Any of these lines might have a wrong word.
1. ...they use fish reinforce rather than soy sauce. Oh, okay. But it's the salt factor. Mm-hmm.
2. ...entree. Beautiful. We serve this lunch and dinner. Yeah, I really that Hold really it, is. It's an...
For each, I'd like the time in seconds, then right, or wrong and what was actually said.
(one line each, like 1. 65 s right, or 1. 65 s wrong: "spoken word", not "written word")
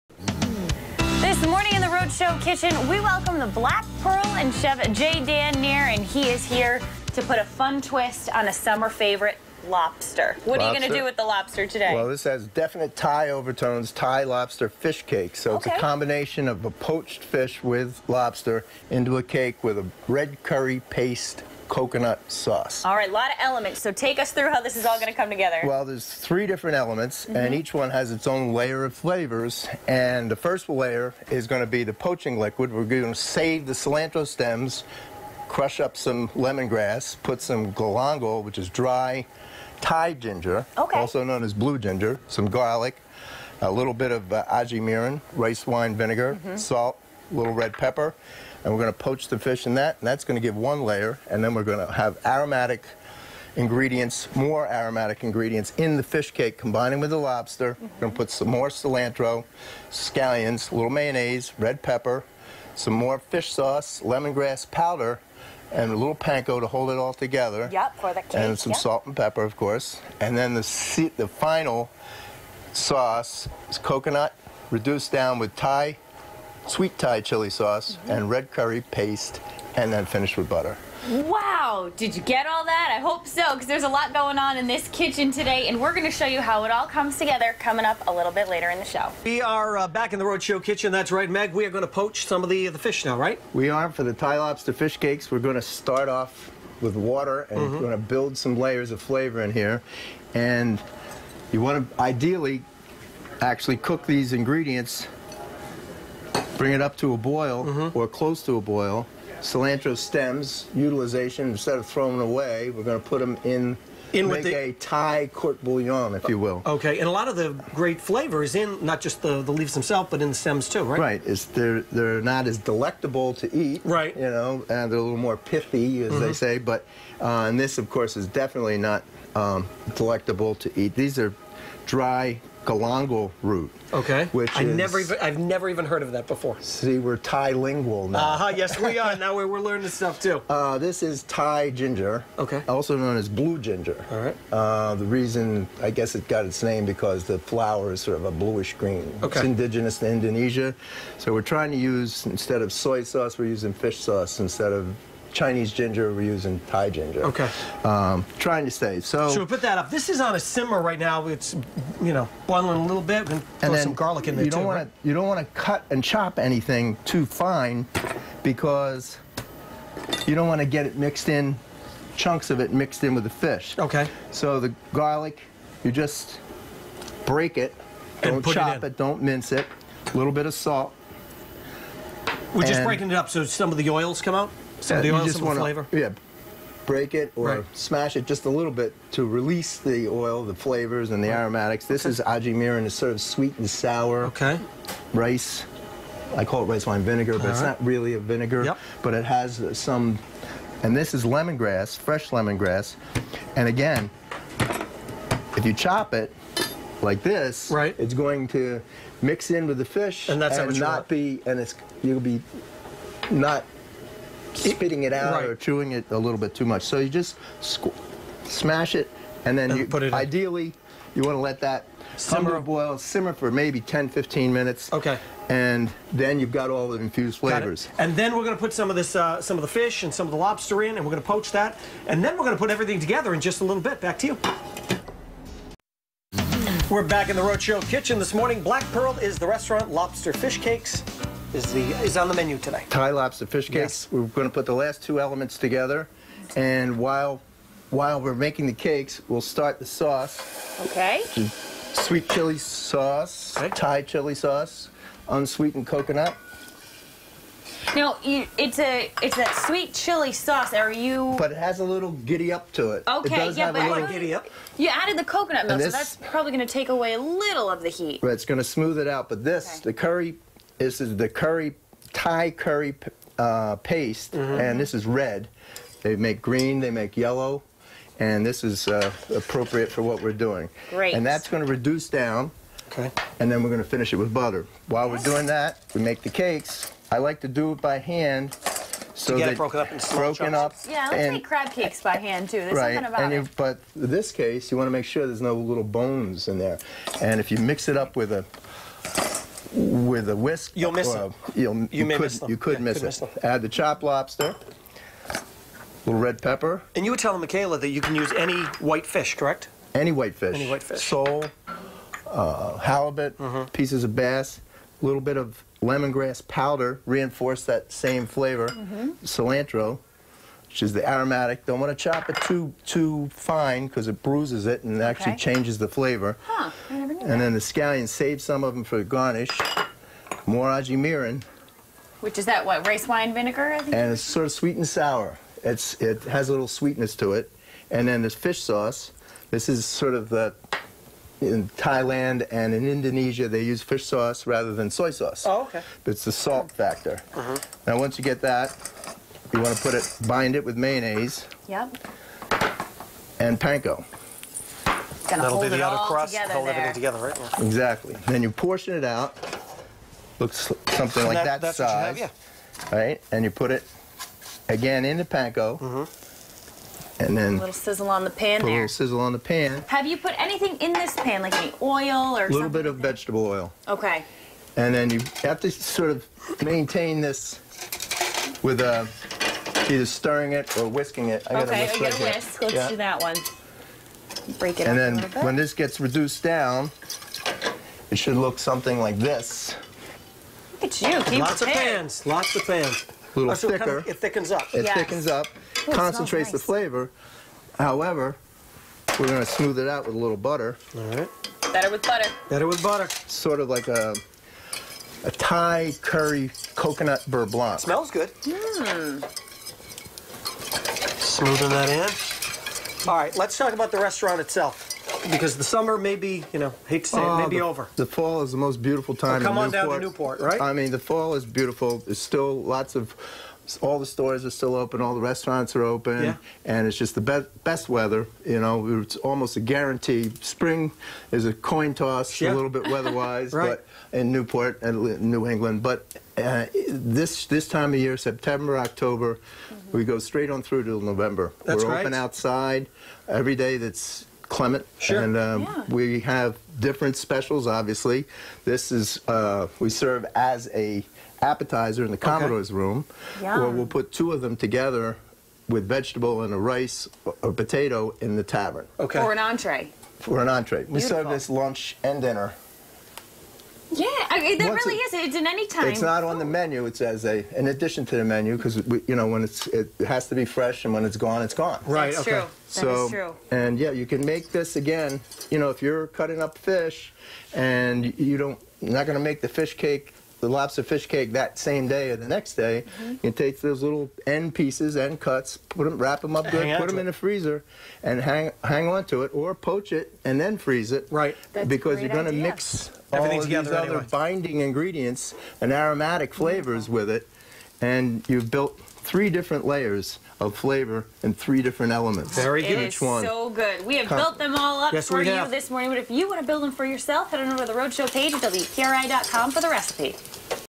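1. 343 s wrong: "sauce", not "reinforce"
2. 460 s wrong: "Once", not "Hold".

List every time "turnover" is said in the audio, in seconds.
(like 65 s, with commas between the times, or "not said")
not said.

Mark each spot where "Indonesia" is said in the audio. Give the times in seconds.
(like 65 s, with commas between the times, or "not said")
150 s, 342 s.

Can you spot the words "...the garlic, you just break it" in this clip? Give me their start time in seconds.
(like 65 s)
174 s.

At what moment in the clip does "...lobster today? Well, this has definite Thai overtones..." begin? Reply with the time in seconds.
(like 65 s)
11 s.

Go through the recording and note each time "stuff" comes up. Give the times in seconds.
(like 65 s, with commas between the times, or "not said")
139 s.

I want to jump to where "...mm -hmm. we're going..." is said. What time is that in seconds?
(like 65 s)
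97 s.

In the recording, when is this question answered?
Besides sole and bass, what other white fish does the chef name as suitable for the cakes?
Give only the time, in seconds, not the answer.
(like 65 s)
312 s.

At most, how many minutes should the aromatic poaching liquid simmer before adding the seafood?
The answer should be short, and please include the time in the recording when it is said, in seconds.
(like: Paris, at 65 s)
15 minutes, at 223 s.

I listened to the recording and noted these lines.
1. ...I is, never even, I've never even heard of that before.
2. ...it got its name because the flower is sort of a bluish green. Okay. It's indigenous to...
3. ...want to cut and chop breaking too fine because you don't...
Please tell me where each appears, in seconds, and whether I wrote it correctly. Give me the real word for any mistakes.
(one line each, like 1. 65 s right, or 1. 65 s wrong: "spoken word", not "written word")
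1. 134 s right
2. 146 s right
3. 165 s wrong: "anything", not "breaking".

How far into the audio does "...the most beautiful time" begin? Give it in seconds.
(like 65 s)
418 s.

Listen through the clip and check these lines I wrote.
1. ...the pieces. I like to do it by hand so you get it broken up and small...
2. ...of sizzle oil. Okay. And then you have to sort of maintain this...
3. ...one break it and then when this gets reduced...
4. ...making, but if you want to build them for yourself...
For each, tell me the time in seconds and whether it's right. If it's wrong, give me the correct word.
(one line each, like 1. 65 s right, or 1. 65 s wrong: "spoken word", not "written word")
1. 286 s wrong: "cakes", not "pieces"
2. 372 s wrong: "vegetable", not "sizzle"
3. 383 s right
4. 505 s wrong: "morning", not "making".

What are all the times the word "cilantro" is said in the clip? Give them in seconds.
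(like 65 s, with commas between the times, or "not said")
33 s, 58 s, 109 s, 319 s.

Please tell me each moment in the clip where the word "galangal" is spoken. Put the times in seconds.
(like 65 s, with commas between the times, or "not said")
37 s, 132 s.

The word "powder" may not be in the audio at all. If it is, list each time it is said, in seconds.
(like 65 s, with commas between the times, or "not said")
64 s, 316 s.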